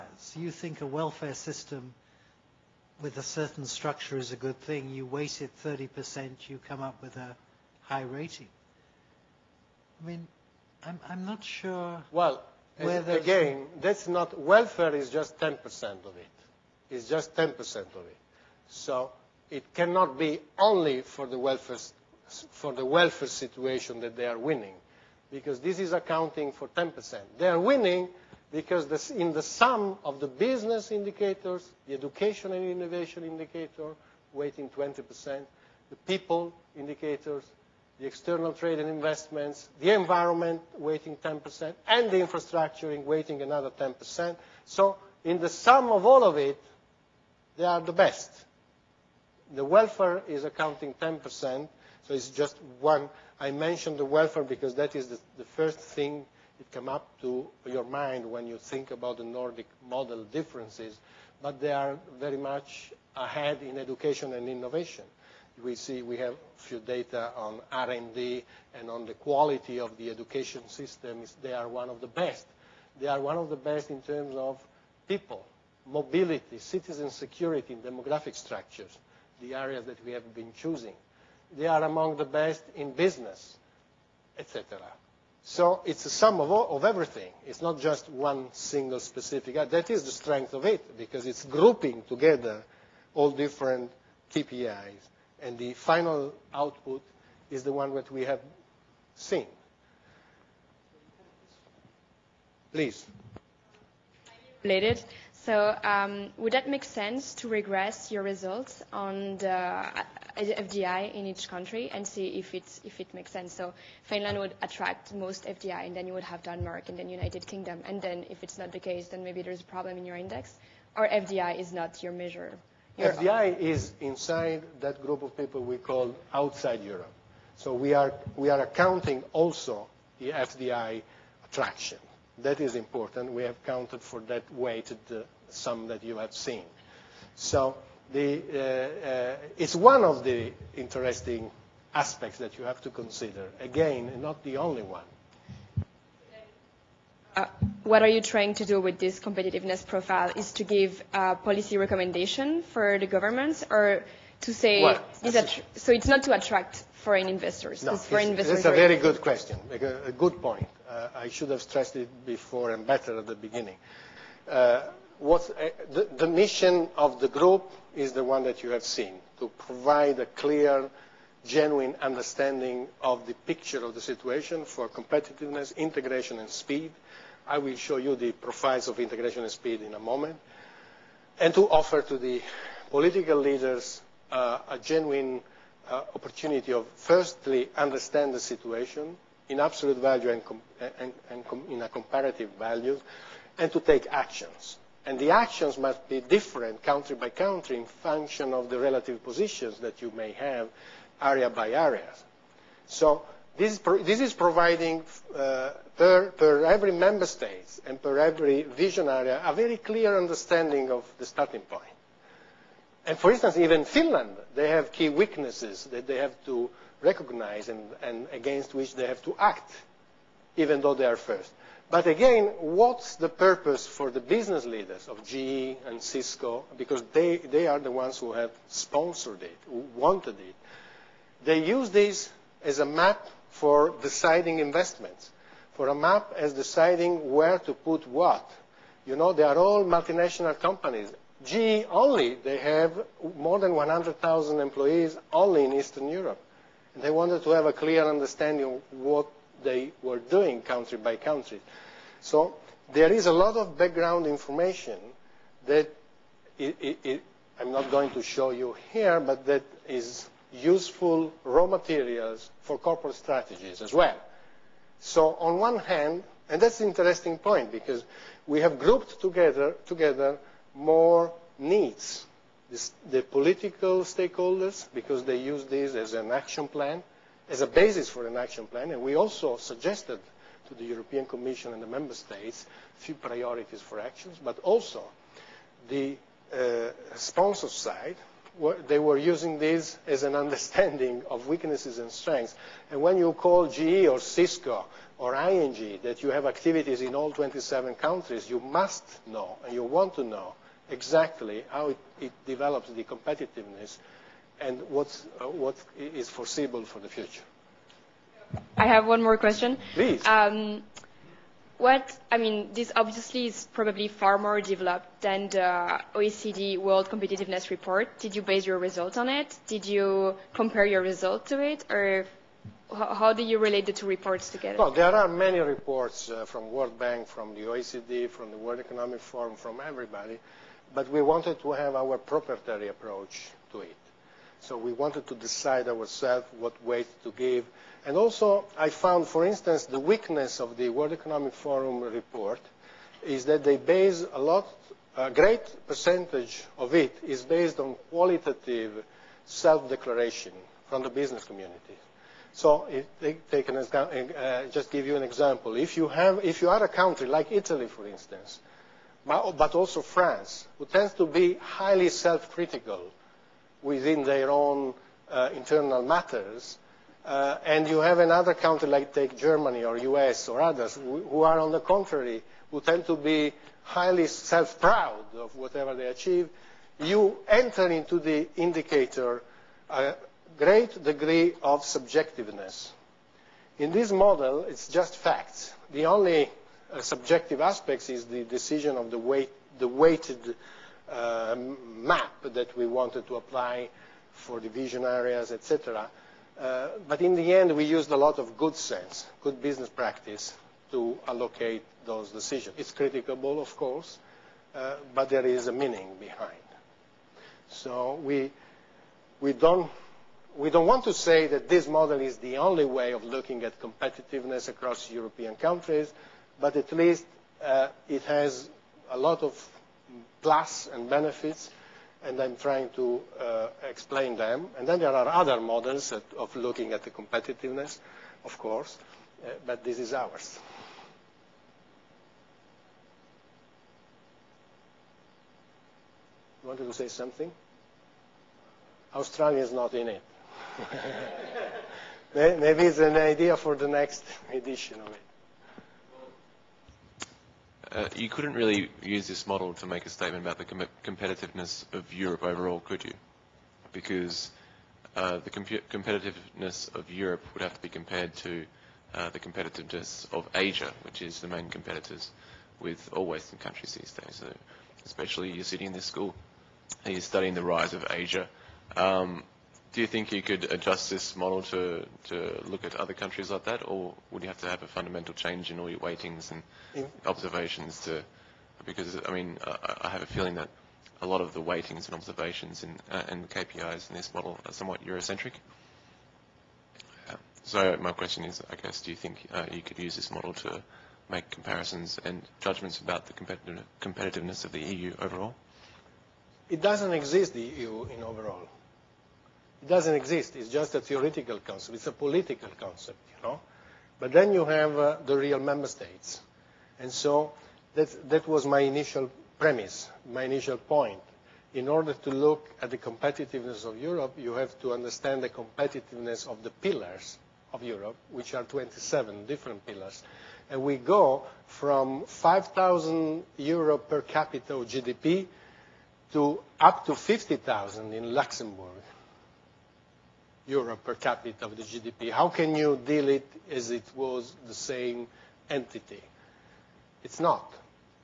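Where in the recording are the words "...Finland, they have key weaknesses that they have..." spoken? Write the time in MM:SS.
03:33.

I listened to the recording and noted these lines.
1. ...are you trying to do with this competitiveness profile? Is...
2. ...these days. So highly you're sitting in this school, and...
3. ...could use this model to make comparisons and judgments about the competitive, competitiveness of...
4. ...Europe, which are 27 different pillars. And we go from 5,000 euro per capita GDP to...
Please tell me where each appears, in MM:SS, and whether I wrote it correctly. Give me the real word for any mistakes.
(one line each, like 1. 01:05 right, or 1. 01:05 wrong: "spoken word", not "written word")
1. 02:28 right
2. 07:43 wrong: "especially", not "highly"
3. 08:09 right
4. 08:37 right.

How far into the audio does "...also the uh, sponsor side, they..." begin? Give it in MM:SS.
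04:44.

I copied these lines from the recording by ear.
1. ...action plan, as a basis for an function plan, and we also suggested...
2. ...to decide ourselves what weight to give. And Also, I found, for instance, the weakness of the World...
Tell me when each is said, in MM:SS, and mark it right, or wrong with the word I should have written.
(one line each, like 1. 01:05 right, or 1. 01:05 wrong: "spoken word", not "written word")
1. 04:36 wrong: "action", not "function"
2. 05:35 right.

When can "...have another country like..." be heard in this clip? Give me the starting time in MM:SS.
06:07.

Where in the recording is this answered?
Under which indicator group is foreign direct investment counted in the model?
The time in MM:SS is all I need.
02:06.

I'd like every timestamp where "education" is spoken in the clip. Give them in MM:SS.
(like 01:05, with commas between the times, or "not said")
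00:31, 01:03, 01:10.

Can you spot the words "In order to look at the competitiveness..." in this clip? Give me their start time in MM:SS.
08:31.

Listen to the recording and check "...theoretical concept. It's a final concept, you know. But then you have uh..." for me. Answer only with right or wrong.
wrong.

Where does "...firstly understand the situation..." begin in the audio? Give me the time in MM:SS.
03:06.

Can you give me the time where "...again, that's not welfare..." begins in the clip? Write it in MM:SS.
00:13.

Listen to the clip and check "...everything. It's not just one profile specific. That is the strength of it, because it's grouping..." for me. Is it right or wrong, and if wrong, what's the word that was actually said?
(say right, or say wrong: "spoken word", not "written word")
wrong: "single", not "profile".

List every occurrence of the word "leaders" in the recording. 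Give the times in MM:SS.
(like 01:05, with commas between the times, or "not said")
03:03, 03:44.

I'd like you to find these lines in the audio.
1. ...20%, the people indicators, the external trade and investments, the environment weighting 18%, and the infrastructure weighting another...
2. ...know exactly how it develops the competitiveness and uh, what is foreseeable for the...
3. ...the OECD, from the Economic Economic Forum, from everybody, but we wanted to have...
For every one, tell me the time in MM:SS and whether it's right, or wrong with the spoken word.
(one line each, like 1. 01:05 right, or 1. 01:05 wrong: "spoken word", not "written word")
1. 00:34 wrong: "10", not "18"
2. 05:00 right
3. 05:27 wrong: "World", not "Economic".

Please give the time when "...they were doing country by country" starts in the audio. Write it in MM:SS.
04:09.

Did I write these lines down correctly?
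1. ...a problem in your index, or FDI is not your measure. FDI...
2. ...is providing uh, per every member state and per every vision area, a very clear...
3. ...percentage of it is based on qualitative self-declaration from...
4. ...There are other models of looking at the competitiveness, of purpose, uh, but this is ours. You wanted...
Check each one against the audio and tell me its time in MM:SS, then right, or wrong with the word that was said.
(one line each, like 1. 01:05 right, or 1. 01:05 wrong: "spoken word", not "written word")
1. 01:59 right
2. 03:24 right
3. 05:45 right
4. 07:04 wrong: "course", not "purpose".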